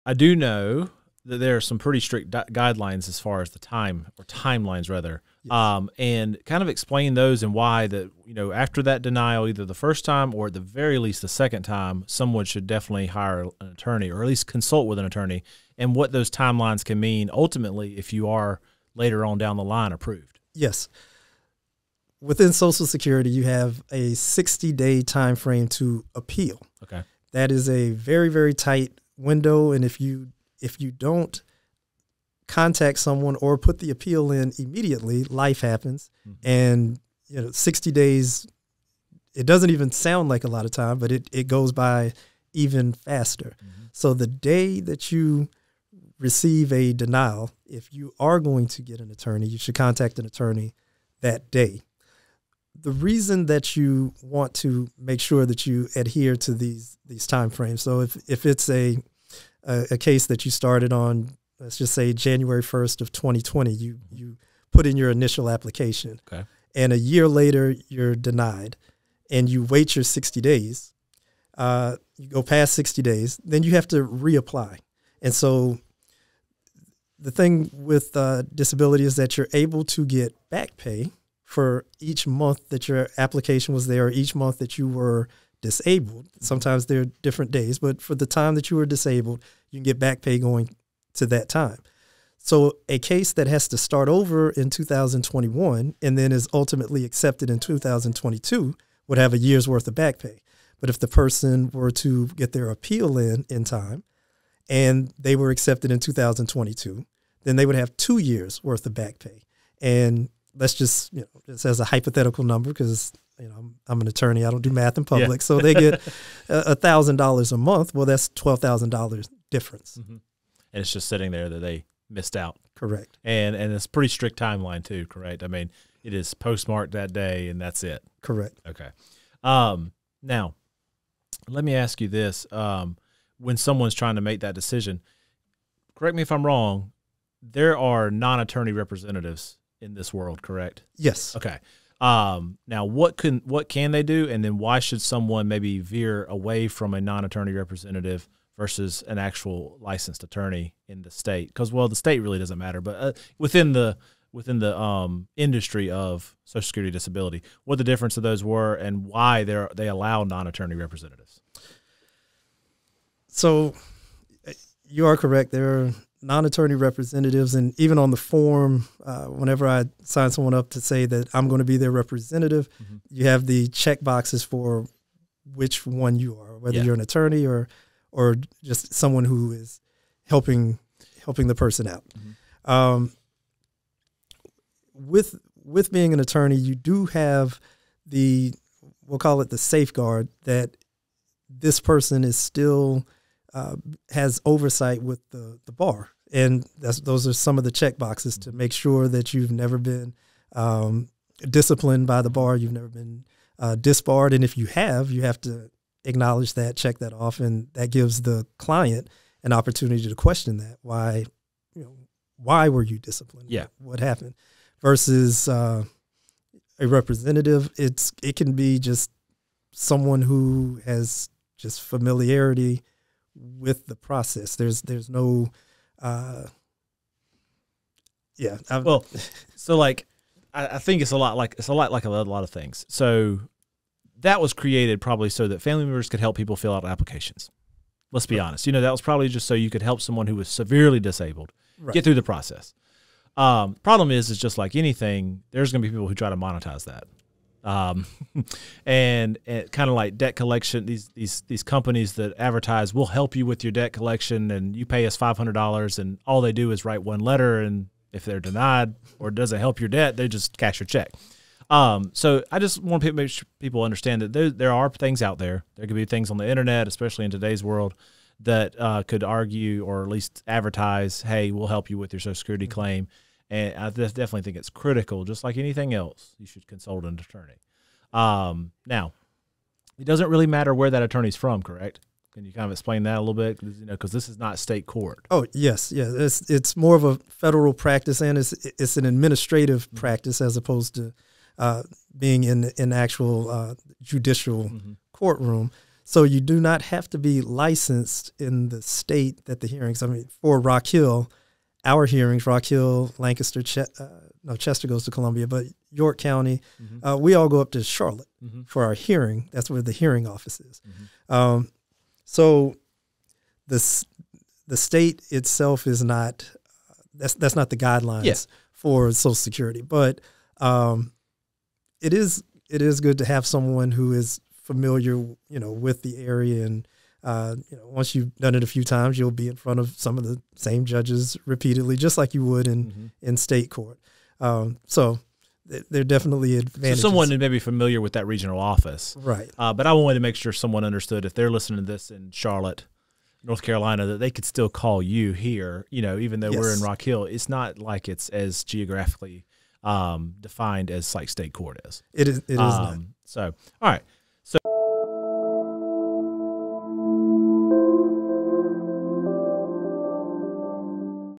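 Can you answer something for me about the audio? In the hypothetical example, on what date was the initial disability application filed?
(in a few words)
January 1st of 2020.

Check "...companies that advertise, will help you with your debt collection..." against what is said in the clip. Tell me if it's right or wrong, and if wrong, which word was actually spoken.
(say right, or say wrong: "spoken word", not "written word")
right.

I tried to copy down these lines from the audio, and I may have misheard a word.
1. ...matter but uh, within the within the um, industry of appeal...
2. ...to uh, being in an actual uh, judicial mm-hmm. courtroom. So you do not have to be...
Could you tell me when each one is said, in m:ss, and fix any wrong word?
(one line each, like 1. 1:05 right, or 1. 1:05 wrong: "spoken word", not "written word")
1. 2:32 wrong: "social", not "appeal"
2. 4:50 right.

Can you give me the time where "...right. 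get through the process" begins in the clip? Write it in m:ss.
4:01.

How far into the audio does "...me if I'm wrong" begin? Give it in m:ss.
2:16.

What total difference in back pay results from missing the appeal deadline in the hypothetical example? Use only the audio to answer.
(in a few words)
$12,000.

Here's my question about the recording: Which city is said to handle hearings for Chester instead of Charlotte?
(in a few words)
Columbia.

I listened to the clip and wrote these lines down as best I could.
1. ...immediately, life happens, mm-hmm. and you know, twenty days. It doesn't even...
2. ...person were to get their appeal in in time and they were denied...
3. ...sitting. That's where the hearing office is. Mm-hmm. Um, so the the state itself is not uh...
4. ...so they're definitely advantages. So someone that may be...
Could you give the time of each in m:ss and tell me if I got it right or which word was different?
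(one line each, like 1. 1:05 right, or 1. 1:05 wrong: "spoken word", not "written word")
1. 0:34 wrong: "sixty", not "twenty"
2. 1:41 wrong: "accepted", not "denied"
3. 5:08 wrong: "hearing", not "sitting"
4. 5:34 right.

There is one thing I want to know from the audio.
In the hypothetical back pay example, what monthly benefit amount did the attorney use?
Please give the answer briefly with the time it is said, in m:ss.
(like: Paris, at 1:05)
$1,000, at 1:56.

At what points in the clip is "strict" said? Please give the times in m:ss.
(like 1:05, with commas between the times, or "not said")
0:01, 2:04.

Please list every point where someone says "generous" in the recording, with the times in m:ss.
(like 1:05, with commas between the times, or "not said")
not said.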